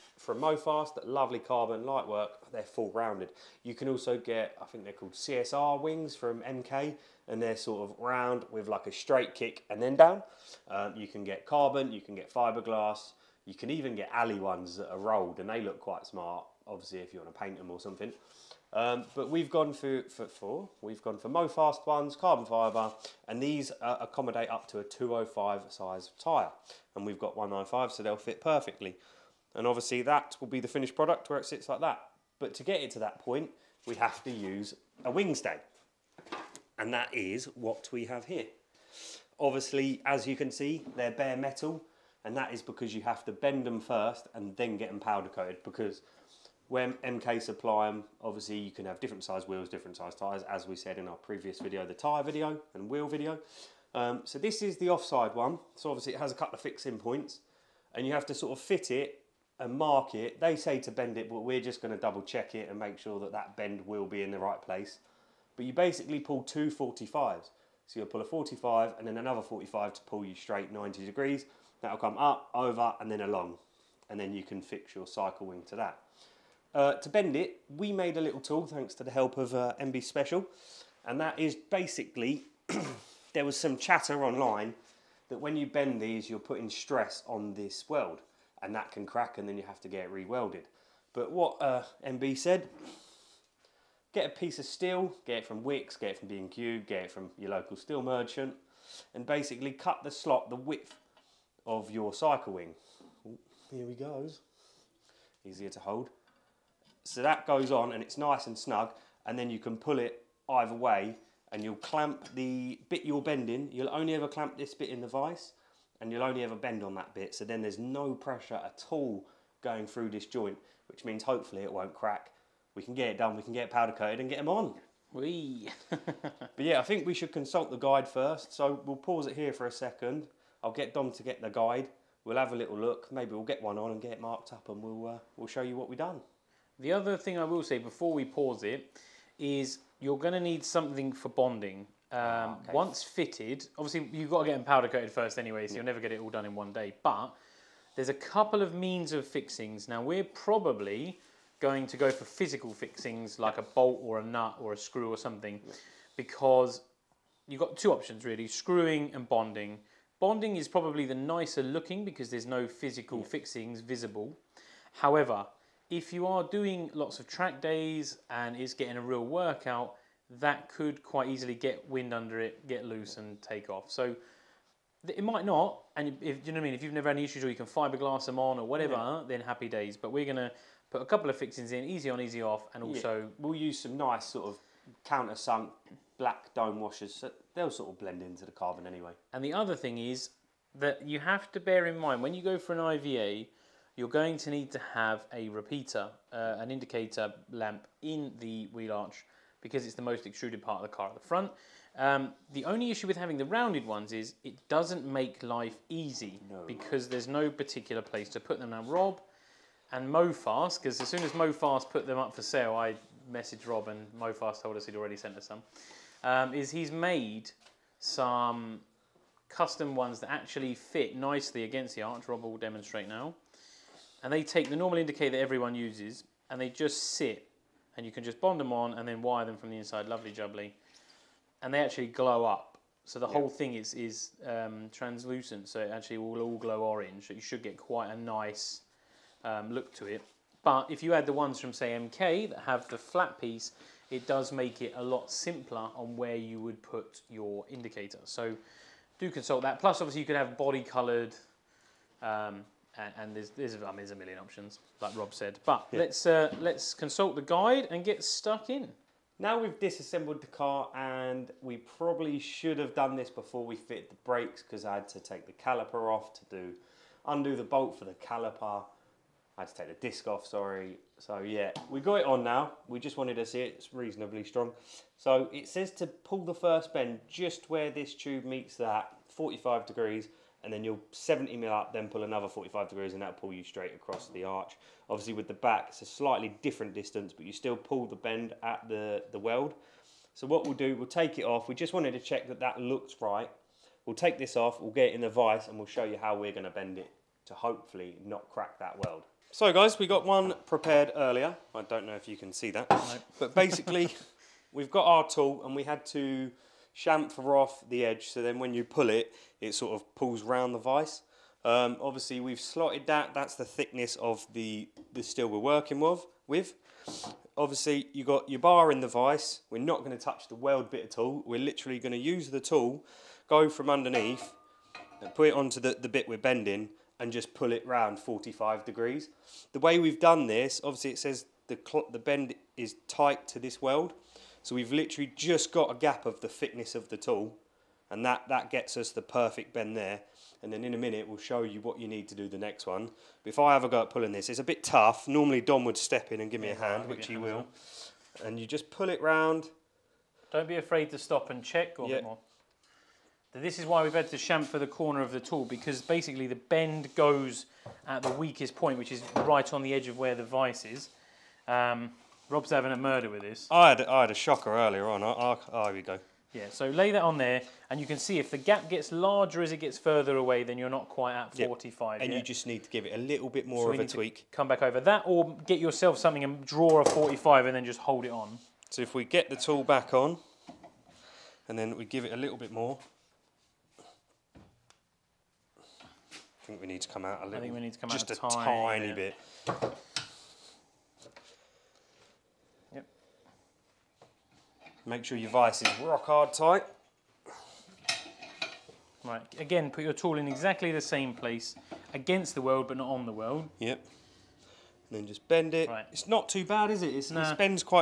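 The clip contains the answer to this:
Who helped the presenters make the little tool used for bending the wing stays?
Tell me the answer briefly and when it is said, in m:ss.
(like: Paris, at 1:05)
MB Special, at 1:19.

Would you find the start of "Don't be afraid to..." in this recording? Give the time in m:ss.
5:50.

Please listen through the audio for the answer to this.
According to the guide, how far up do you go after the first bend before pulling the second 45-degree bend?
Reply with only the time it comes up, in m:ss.
4:41.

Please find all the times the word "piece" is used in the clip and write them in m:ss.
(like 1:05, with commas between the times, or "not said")
1:34, 4:03.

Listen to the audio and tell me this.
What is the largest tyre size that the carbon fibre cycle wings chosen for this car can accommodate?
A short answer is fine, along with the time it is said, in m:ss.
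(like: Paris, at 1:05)
205, at 0:24.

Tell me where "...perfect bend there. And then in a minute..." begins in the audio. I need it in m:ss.
5:39.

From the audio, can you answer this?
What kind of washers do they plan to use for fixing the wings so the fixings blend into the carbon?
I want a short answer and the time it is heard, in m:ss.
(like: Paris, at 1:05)
countersunk black dome washers, at 3:05.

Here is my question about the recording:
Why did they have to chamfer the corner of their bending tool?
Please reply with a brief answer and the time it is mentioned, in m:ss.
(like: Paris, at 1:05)
the bend goes at the weakest point, at 5:56.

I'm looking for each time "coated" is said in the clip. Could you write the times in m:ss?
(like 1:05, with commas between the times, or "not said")
0:45, 2:03, 2:24.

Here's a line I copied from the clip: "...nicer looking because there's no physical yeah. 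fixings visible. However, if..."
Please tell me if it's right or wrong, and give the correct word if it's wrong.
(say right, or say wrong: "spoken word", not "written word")
right.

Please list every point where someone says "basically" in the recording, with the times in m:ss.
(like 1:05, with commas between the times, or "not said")
1:05, 1:21, 1:39, 5:03, 5:56.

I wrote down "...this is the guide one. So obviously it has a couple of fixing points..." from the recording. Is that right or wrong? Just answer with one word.
wrong.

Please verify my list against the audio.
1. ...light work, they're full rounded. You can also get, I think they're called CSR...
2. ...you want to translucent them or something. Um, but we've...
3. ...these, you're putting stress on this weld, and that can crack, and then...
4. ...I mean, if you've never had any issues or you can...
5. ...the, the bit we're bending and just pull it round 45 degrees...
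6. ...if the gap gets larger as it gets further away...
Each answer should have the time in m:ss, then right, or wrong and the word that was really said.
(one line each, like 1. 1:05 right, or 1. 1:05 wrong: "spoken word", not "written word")
1. 0:01 right
2. 0:17 wrong: "paint", not "translucent"
3. 1:26 right
4. 2:56 right
5. 5:25 right
6. 6:08 right.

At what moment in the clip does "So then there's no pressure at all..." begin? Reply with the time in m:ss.
1:57.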